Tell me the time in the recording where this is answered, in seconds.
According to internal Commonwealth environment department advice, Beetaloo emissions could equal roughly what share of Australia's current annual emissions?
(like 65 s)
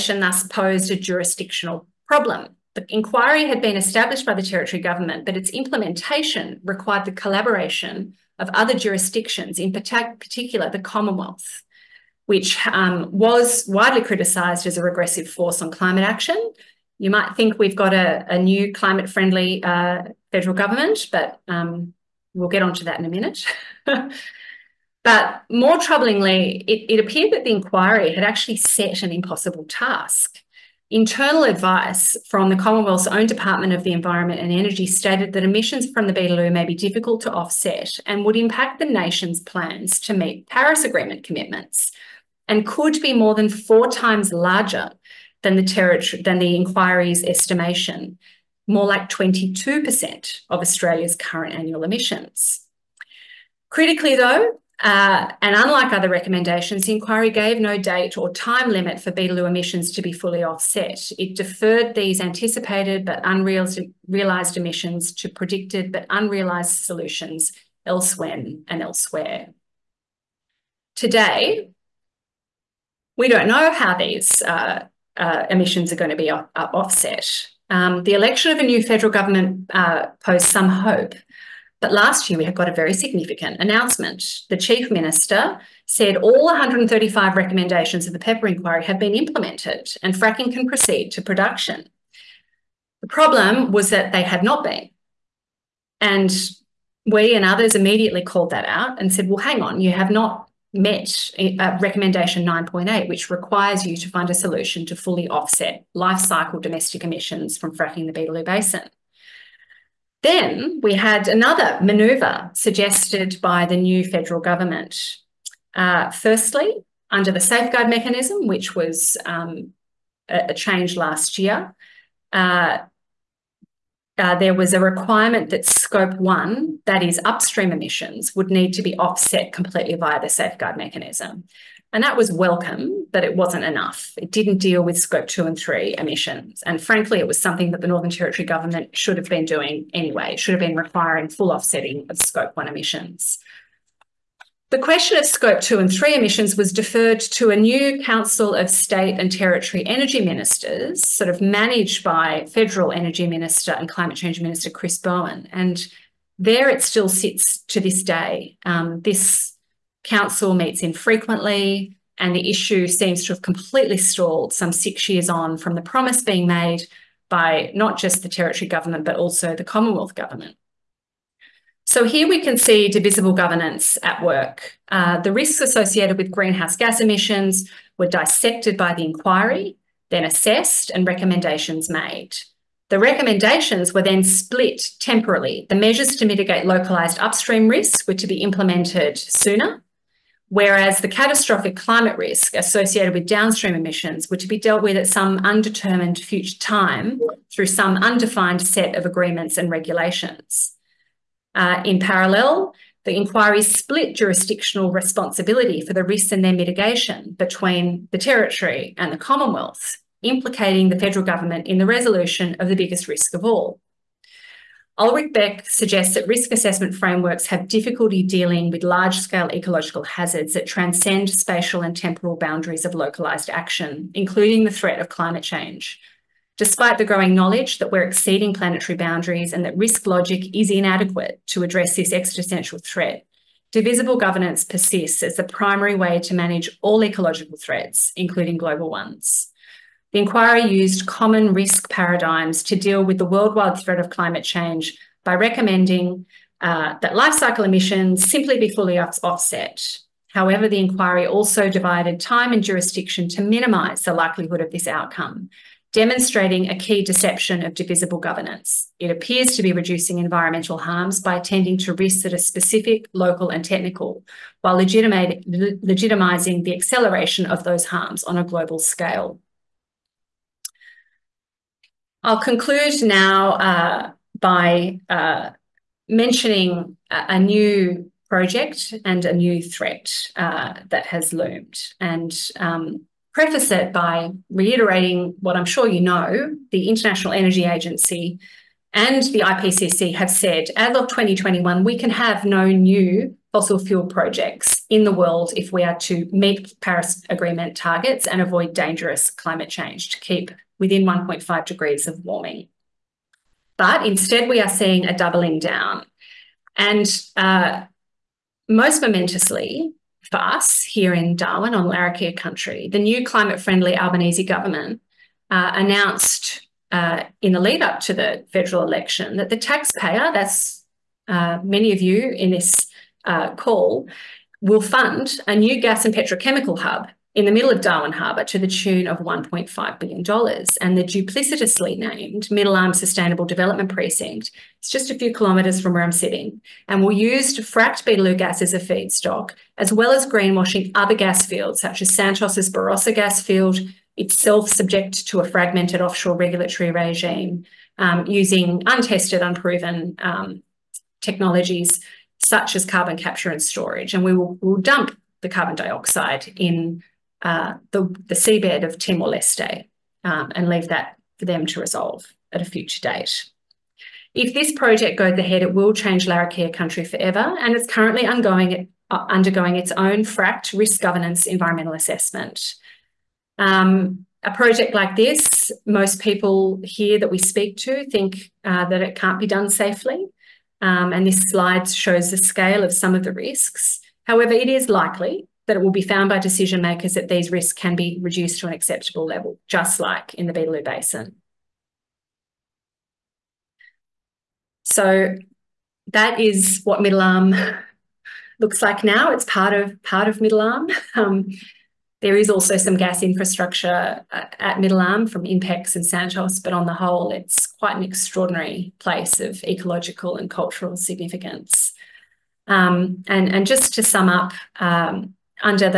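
49 s.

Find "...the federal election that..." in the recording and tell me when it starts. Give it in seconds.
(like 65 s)
318 s.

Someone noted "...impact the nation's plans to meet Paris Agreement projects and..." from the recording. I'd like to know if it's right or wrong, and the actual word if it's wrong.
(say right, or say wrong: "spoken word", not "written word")
wrong: "commitments", not "projects".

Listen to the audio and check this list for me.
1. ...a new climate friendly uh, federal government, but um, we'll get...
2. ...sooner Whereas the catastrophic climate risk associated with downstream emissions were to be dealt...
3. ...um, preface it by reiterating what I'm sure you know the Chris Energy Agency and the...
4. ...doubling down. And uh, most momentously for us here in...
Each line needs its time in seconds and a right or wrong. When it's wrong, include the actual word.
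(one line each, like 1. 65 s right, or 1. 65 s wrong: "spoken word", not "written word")
1. 18 s right
2. 189 s right
3. 282 s wrong: "International", not "Chris"
4. 305 s right.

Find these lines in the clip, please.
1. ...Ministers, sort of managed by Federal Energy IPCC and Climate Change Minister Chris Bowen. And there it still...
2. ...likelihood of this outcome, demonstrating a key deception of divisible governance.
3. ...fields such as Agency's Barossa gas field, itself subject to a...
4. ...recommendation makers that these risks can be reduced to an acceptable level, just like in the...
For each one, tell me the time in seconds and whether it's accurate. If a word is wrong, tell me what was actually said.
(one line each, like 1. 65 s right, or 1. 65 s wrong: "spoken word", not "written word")
1. 150 s wrong: "Minister", not "IPCC"
2. 254 s right
3. 341 s wrong: "Santos", not "Agency"
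4. 386 s wrong: "decision", not "recommendation".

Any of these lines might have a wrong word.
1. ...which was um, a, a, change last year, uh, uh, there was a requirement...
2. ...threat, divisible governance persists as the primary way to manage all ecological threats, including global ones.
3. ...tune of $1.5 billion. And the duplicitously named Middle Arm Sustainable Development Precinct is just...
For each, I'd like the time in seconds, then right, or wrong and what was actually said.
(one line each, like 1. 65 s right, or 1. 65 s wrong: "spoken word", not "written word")
1. 118 s right
2. 232 s right
3. 328 s right.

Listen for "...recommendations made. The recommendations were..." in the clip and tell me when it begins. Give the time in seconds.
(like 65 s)
181 s.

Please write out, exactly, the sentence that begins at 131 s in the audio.
And that was welcome, but it wasn't enough.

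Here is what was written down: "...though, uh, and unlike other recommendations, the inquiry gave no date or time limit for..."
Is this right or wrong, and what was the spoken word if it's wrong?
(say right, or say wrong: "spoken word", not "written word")
right.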